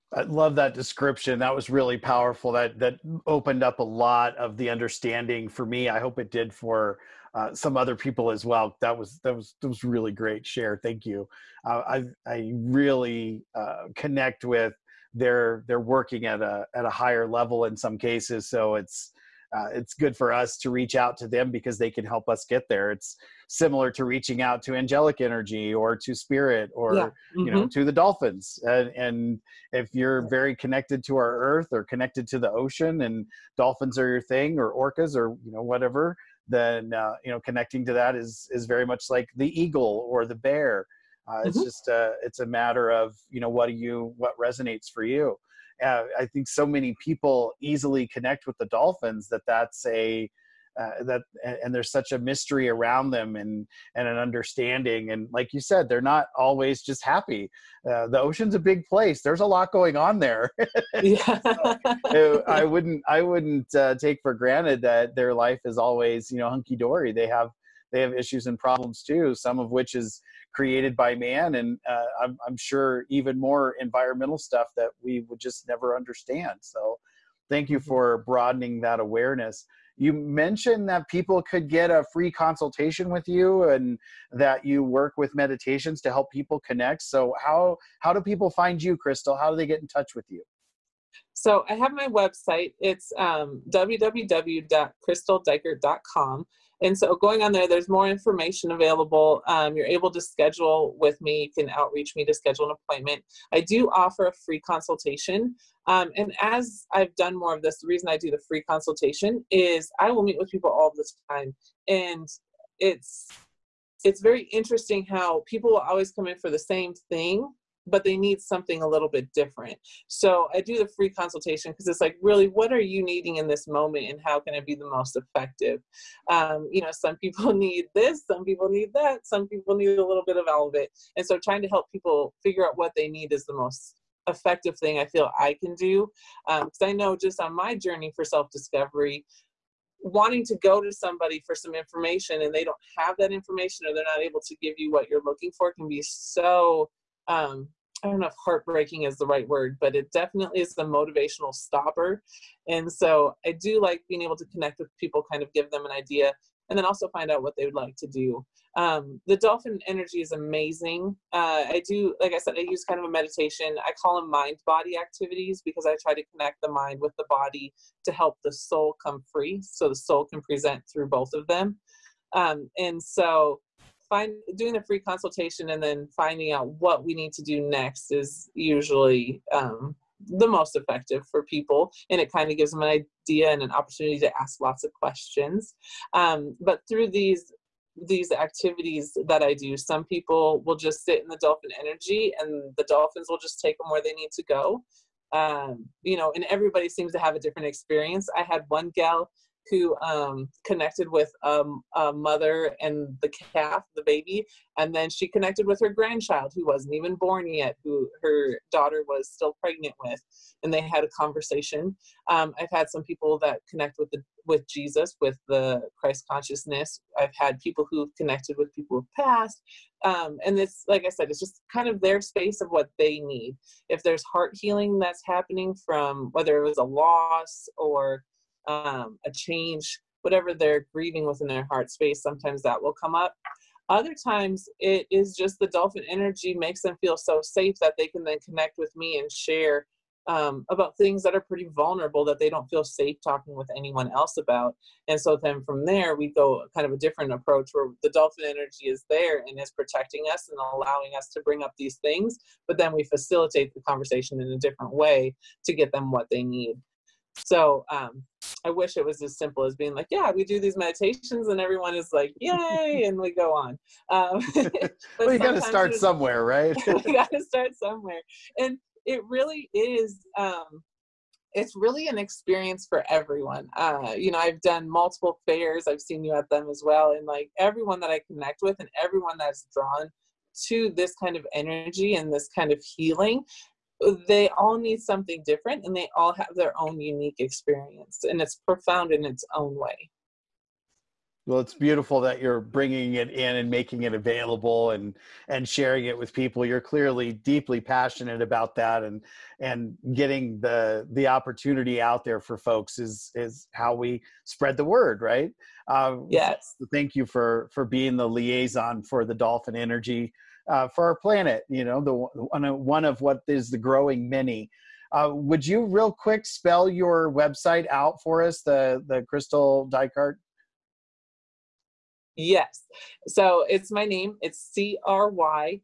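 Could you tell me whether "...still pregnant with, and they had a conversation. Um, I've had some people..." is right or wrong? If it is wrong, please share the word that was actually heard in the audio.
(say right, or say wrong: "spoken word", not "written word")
right.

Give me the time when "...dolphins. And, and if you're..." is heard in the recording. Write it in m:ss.
0:27.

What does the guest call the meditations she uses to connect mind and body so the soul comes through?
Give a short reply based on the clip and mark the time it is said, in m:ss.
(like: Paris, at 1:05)
mind body activities, at 2:44.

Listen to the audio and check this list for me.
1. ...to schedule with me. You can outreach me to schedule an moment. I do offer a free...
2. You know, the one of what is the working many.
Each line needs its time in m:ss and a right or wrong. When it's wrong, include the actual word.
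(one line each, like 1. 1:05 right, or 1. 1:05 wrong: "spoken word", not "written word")
1. 1:40 wrong: "appointment", not "moment"
2. 5:11 wrong: "growing", not "working".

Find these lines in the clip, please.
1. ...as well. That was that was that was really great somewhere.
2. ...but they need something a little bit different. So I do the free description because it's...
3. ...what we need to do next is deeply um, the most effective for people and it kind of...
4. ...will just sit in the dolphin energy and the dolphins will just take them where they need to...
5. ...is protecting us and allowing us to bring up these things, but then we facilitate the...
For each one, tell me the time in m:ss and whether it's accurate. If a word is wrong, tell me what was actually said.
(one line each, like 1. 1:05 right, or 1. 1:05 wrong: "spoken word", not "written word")
1. 0:08 wrong: "share", not "somewhere"
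2. 1:57 wrong: "consultation", not "description"
3. 2:56 wrong: "usually", not "deeply"
4. 3:10 right
5. 4:09 right.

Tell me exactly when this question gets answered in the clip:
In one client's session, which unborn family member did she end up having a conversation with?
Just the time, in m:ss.
3:25.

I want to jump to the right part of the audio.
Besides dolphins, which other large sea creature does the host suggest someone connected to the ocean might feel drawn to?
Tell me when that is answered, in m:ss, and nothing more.
0:34.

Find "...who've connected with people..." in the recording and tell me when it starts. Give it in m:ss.
3:37.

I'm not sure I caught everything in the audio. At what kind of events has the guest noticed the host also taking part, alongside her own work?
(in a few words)
fairs.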